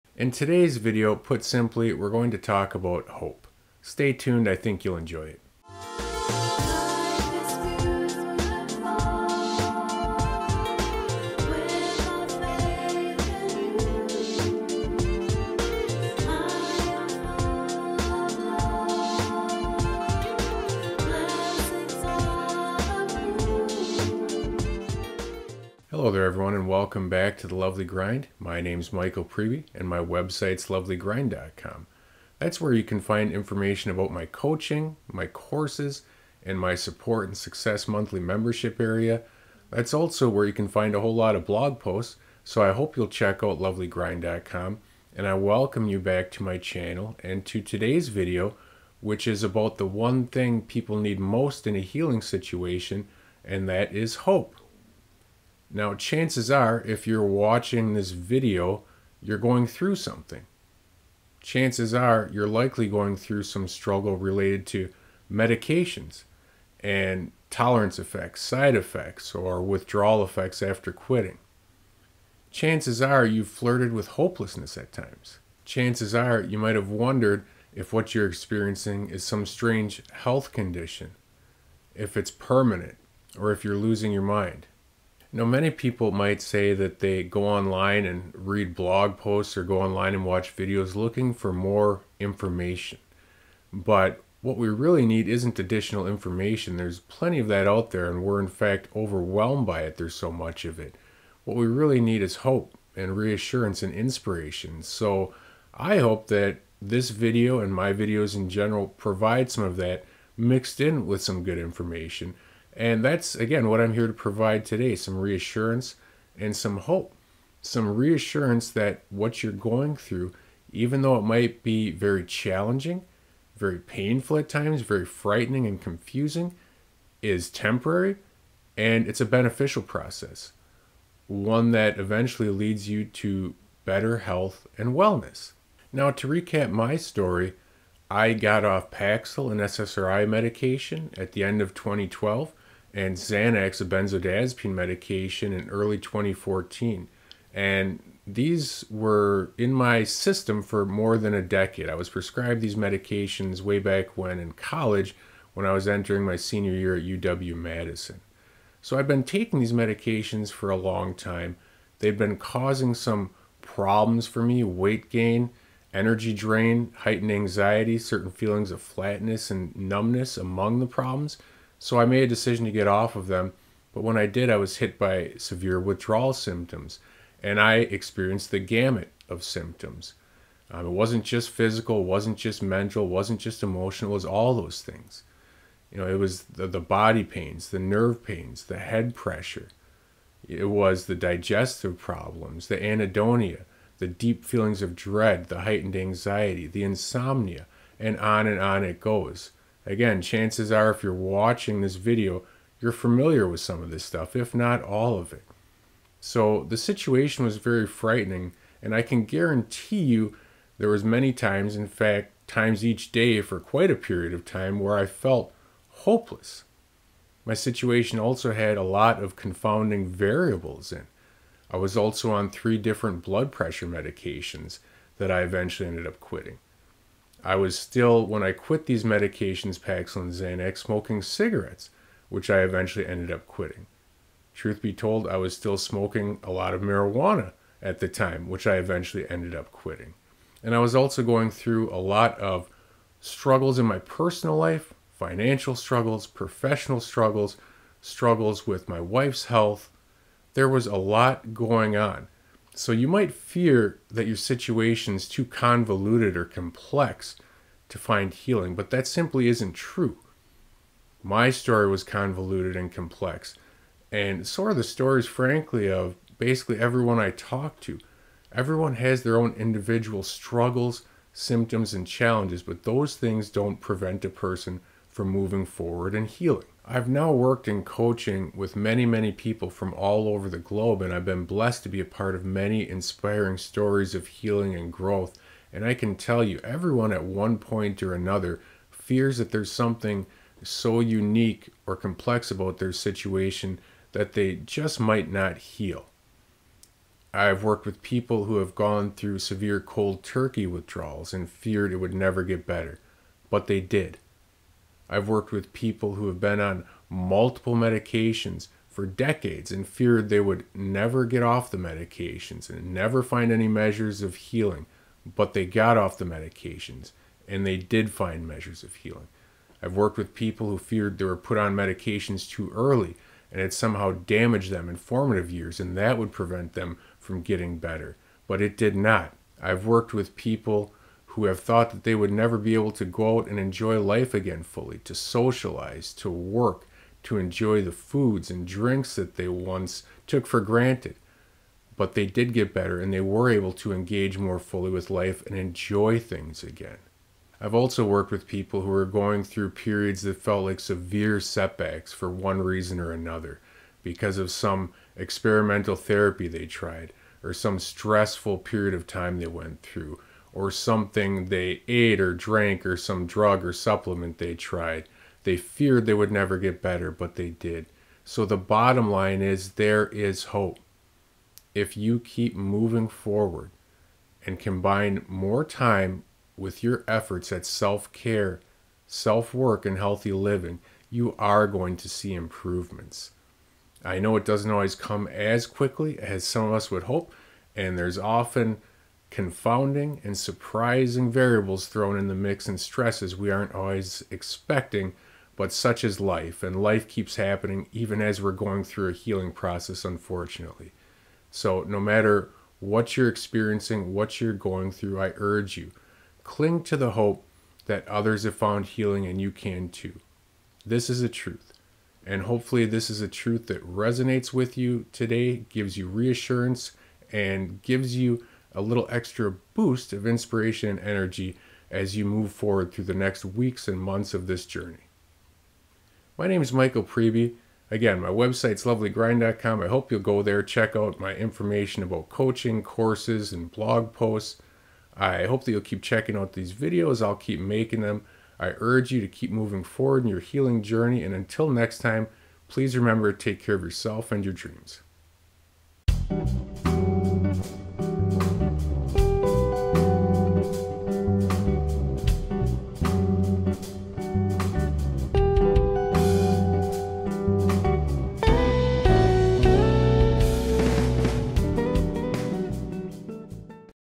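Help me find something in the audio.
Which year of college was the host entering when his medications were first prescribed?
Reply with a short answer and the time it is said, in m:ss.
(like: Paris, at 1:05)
Senior year, at 2:36.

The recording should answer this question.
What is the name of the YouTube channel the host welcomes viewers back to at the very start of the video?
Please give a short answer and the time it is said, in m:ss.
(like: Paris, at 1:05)
The Lovely Grind, at 0:27.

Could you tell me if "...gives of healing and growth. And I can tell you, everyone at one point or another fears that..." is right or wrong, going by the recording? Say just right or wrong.
wrong.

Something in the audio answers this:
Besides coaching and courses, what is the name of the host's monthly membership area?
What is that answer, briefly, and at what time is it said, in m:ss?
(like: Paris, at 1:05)
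Support and Success, at 0:36.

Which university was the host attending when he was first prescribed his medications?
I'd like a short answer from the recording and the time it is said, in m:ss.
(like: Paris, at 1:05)
UW Madison, at 2:37.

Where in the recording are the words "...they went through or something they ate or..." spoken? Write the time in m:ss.
5:59.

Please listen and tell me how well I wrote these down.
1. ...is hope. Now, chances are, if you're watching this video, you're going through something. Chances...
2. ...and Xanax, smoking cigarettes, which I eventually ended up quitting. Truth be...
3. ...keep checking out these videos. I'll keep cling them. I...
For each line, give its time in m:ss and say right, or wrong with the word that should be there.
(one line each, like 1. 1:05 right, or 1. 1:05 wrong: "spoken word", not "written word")
1. 0:53 right
2. 3:50 right
3. 7:15 wrong: "making", not "cling".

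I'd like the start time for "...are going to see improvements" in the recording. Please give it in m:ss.
6:21.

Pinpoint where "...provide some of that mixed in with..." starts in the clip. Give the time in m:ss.
1:48.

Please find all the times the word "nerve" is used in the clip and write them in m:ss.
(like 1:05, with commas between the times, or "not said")
3:07.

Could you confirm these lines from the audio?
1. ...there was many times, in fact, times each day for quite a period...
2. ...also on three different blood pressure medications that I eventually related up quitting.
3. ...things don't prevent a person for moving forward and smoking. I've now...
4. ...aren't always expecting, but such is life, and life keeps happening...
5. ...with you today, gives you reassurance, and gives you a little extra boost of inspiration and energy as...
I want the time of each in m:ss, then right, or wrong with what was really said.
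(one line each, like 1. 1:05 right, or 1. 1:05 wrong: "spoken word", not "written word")
1. 3:30 right
2. 3:41 wrong: "ended", not "related"
3. 4:33 wrong: "healing", not "smoking"
4. 6:33 right
5. 6:54 right.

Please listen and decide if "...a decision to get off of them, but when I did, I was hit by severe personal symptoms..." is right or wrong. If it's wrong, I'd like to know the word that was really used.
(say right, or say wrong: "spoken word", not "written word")
wrong: "withdrawal", not "personal".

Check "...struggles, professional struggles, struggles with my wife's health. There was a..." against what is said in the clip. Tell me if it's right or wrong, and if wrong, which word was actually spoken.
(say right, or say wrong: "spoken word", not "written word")
right.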